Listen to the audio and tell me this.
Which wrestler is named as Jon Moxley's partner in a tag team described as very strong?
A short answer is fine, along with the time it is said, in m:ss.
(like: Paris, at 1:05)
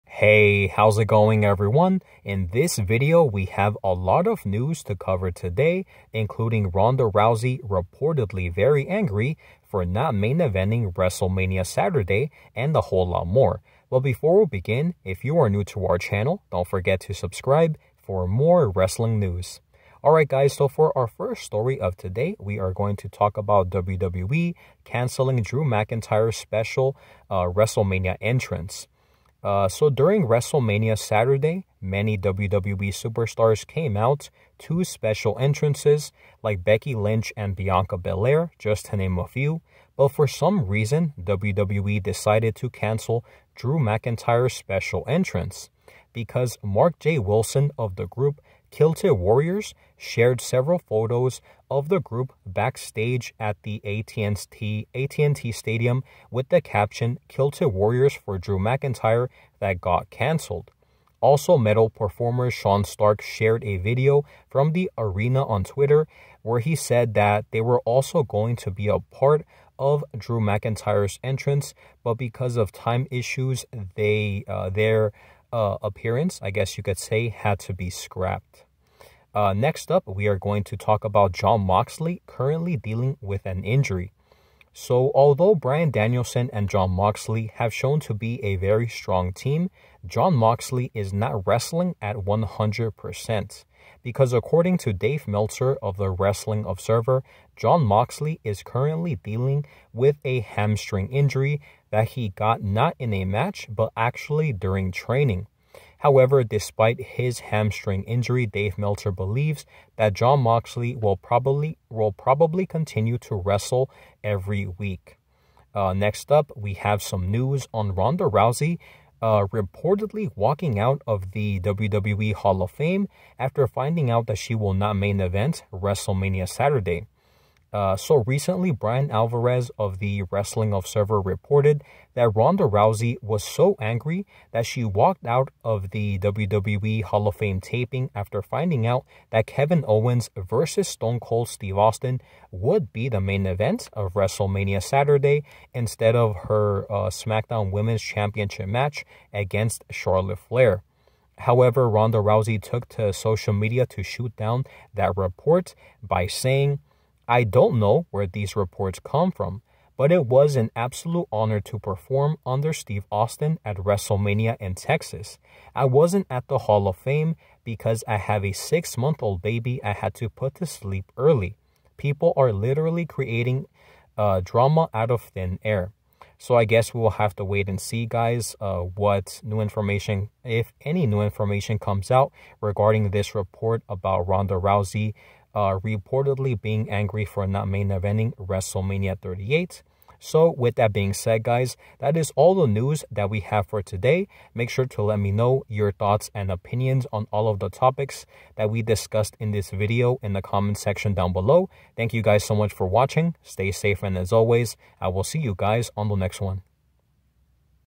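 Bryan Danielson, at 1:25.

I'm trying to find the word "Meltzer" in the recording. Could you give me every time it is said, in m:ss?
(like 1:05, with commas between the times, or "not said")
1:35, 1:48.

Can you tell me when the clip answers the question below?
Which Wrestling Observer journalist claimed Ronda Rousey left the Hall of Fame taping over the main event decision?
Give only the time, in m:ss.
2:08.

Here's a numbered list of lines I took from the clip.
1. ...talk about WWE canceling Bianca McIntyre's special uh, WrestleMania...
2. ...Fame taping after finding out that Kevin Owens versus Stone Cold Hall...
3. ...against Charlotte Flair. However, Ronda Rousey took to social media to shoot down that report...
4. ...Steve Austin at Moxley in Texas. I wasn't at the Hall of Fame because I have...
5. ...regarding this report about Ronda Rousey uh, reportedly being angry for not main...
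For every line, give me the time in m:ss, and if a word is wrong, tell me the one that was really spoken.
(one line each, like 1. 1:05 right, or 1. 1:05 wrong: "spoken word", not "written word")
1. 0:23 wrong: "Drew", not "Bianca"
2. 2:17 wrong: "Steve", not "Hall"
3. 2:29 right
4. 2:42 wrong: "WrestleMania", not "Moxley"
5. 3:02 right.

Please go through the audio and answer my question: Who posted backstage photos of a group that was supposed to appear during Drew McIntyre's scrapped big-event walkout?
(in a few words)
Mark J. Wilson.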